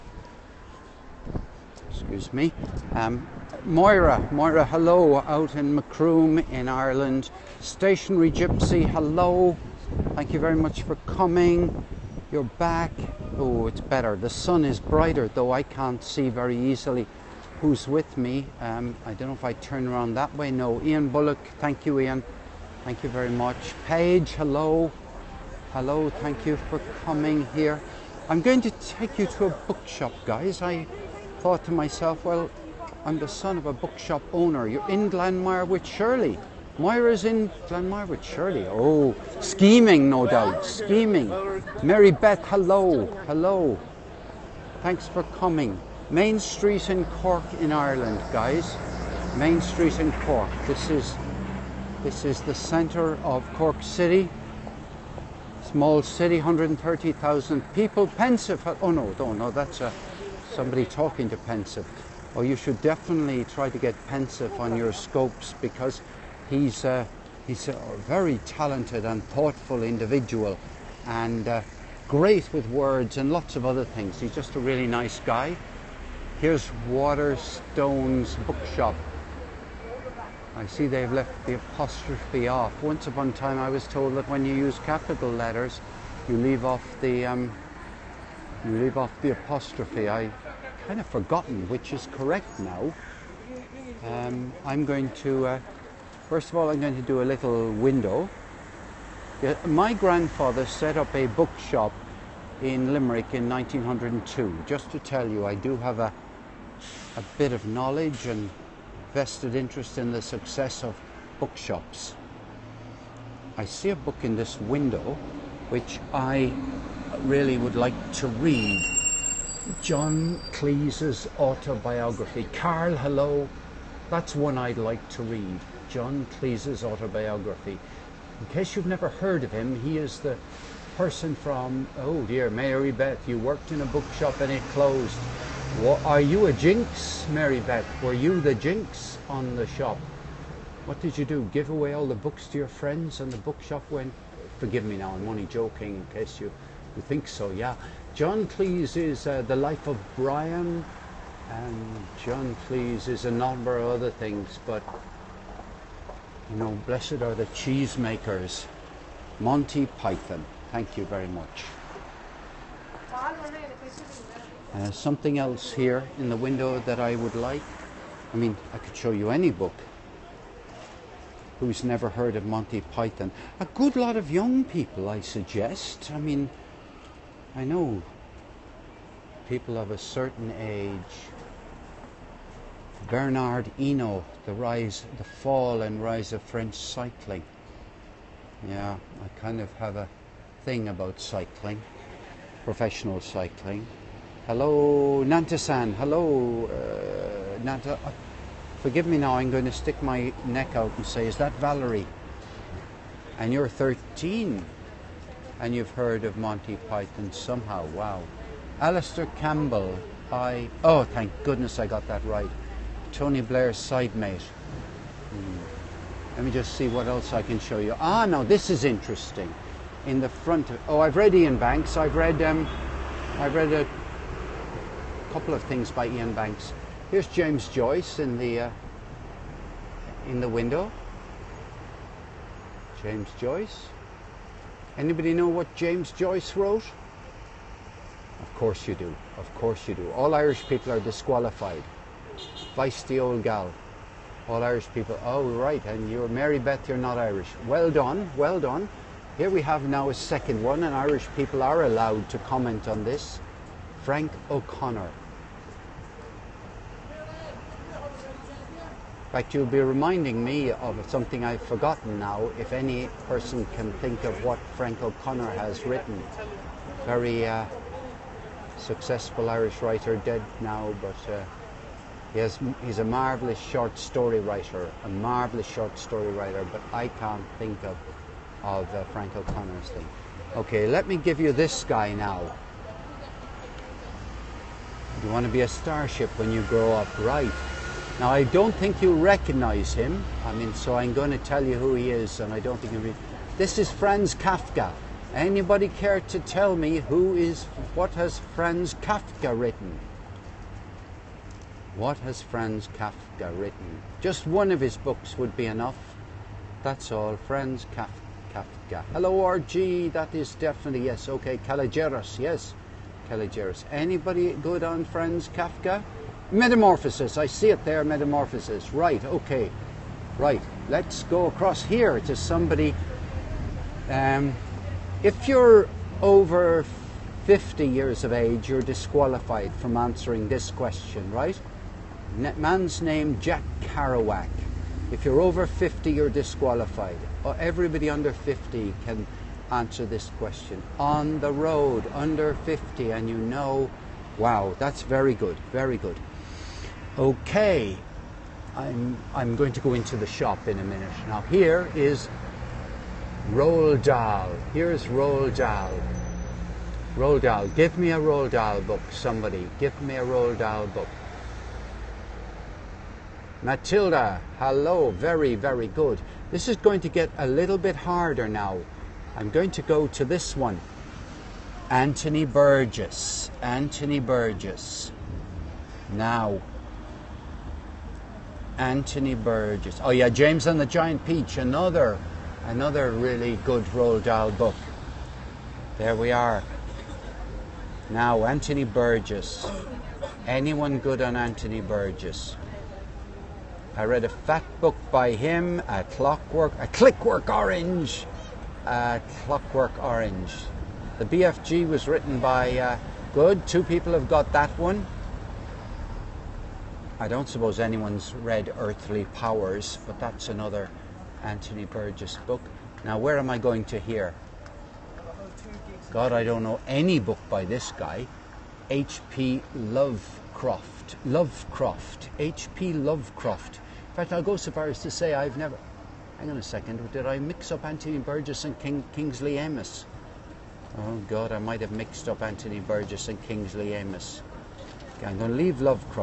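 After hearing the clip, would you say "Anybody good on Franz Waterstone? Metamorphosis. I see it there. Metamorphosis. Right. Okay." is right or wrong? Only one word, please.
wrong.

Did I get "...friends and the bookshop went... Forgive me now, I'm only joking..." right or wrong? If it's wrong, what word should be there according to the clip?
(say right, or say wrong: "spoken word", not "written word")
right.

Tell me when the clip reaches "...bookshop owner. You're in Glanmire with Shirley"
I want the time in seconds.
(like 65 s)
33 s.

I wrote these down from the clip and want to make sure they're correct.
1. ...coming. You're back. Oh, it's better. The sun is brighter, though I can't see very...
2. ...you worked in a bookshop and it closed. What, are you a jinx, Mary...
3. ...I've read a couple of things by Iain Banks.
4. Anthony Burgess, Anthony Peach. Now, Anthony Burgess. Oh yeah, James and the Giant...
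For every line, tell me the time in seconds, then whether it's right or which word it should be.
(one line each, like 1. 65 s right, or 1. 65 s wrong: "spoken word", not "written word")
1. 11 s right
2. 133 s right
3. 223 s right
4. 371 s wrong: "Burgess", not "Peach".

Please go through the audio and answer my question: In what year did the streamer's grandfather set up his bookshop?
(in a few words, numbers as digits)
1902.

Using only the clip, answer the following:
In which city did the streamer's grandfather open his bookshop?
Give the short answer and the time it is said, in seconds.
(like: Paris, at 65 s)
Limerick, at 102 s.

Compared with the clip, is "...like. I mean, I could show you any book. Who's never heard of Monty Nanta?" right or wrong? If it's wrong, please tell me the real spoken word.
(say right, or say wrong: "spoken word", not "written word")
wrong: "Python", not "Nanta".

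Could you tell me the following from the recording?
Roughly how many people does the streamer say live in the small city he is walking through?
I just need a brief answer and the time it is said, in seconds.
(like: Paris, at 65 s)
130,000, at 56 s.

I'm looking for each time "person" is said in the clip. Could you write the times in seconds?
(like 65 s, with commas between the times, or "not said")
130 s, 263 s.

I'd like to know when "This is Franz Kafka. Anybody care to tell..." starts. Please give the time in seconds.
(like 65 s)
293 s.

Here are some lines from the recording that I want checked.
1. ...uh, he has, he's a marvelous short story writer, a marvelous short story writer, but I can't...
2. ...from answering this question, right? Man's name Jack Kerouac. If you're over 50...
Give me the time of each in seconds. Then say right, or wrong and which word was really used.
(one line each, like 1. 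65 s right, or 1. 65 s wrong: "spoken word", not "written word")
1. 271 s right
2. 329 s right.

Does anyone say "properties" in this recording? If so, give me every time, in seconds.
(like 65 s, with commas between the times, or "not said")
not said.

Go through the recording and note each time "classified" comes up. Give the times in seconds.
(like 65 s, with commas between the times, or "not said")
not said.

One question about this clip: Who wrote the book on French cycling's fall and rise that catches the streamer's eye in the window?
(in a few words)
Bernard Hinault.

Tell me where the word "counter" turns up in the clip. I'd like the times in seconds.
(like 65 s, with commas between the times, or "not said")
not said.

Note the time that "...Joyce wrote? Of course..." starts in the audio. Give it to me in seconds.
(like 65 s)
236 s.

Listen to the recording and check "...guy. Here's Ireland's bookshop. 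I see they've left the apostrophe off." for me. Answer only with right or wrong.
wrong.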